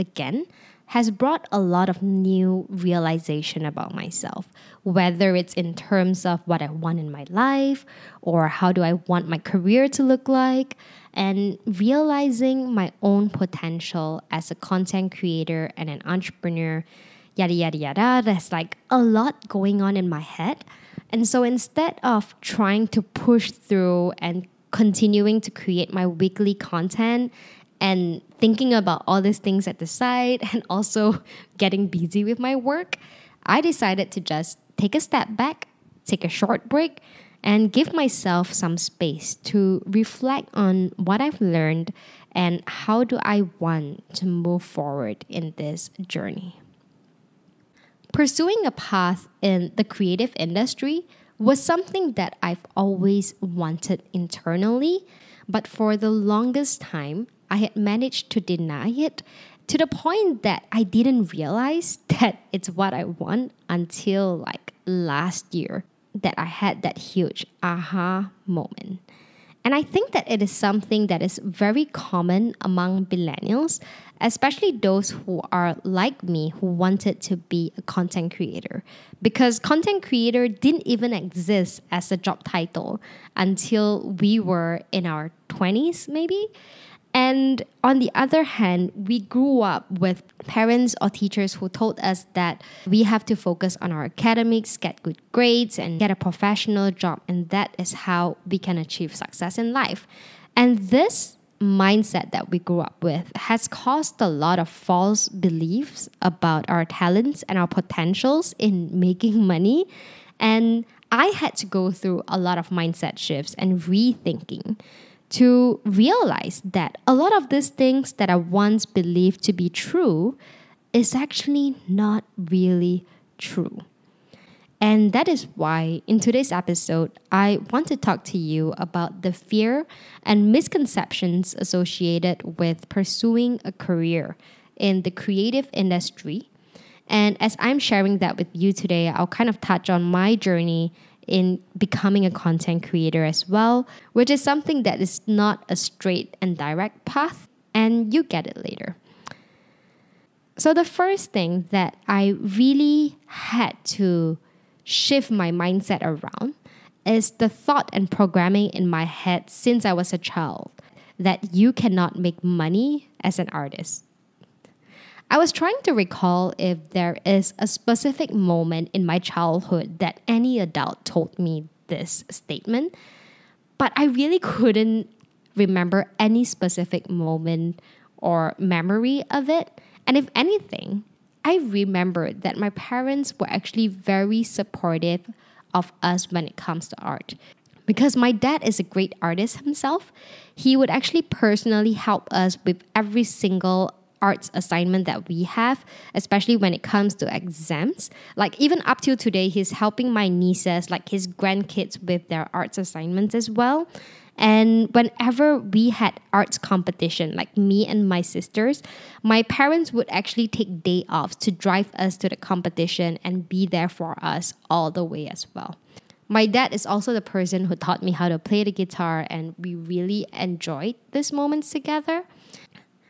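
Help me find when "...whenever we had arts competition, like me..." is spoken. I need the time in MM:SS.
03:24.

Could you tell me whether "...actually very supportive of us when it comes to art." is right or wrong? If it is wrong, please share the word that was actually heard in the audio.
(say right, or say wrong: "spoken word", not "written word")
right.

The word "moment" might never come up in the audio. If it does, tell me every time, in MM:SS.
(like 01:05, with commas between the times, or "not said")
01:08, 02:48, 02:57, 03:41.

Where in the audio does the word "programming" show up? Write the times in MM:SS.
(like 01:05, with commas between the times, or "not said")
02:38.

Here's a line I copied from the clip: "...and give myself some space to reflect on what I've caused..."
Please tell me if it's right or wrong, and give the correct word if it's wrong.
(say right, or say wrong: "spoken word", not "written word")
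wrong: "learned", not "caused".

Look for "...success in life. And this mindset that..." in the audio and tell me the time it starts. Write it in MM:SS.
01:39.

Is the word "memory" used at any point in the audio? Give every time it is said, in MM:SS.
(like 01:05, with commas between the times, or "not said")
02:58.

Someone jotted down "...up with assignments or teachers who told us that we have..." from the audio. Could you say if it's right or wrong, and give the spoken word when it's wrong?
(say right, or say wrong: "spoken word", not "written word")
wrong: "parents", not "assignments".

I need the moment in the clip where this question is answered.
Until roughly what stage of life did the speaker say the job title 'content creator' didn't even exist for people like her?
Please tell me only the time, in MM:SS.
01:24.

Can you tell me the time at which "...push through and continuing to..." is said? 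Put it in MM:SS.
00:23.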